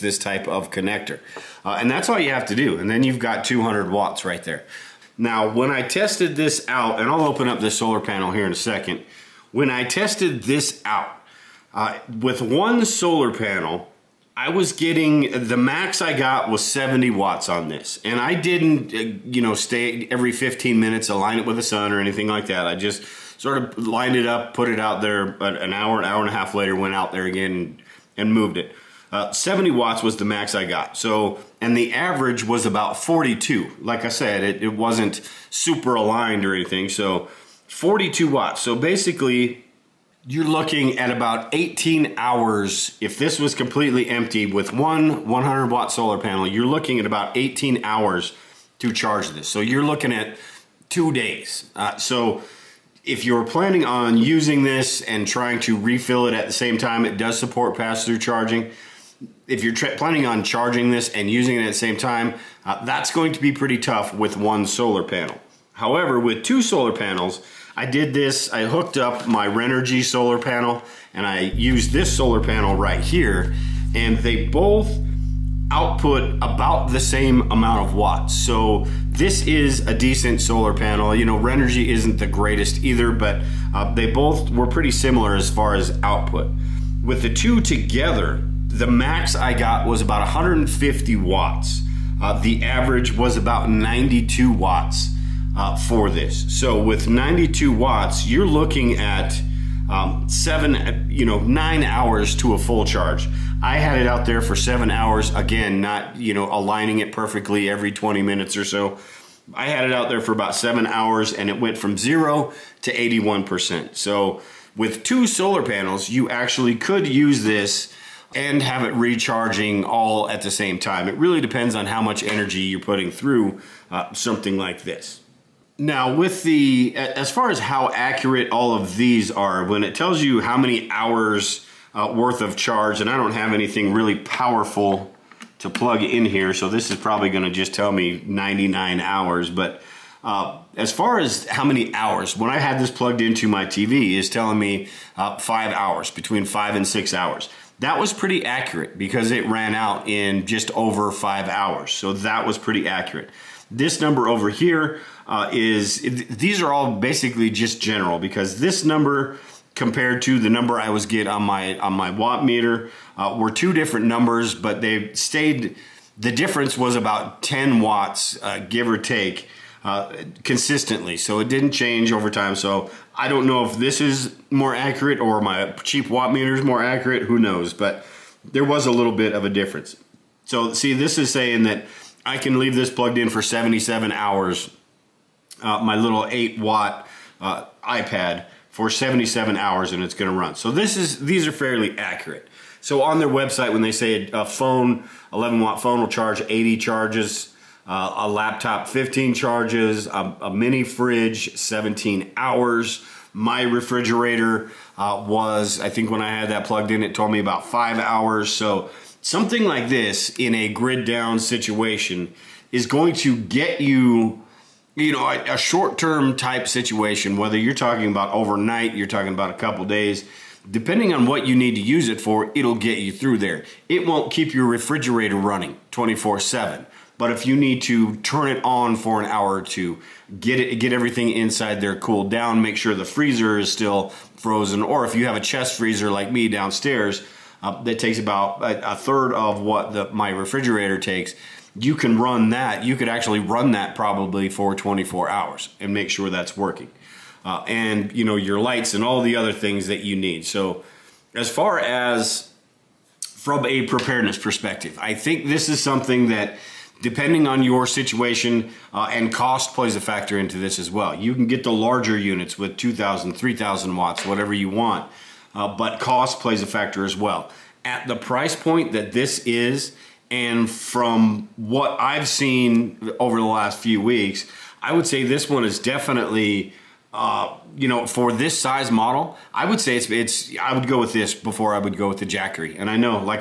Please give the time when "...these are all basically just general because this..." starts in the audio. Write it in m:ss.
2:36.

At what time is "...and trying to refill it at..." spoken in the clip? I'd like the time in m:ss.
0:55.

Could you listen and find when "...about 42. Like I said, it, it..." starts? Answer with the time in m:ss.
0:32.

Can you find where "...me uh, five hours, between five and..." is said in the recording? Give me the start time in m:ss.
2:24.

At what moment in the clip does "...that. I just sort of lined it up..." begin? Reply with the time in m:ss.
0:22.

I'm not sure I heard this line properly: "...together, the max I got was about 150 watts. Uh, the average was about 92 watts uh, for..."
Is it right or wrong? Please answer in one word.
right.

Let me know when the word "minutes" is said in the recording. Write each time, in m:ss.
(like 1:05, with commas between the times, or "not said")
0:20, 1:48.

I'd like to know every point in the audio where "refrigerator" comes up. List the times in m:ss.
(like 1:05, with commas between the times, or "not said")
3:23, 3:44, 4:00.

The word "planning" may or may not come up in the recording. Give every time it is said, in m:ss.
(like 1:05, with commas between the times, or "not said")
0:53, 0:59.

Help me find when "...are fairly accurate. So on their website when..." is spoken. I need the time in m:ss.
3:11.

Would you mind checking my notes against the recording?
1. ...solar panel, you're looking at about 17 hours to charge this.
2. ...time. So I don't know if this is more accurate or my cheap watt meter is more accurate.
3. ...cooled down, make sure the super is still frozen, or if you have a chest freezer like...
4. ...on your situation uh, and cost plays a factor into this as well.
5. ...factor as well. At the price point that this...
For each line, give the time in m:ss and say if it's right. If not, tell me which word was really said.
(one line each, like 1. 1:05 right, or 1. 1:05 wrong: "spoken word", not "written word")
1. 0:45 wrong: "18", not "17"
2. 2:52 right
3. 3:51 wrong: "freezer", not "super"
4. 4:17 right
5. 4:26 right.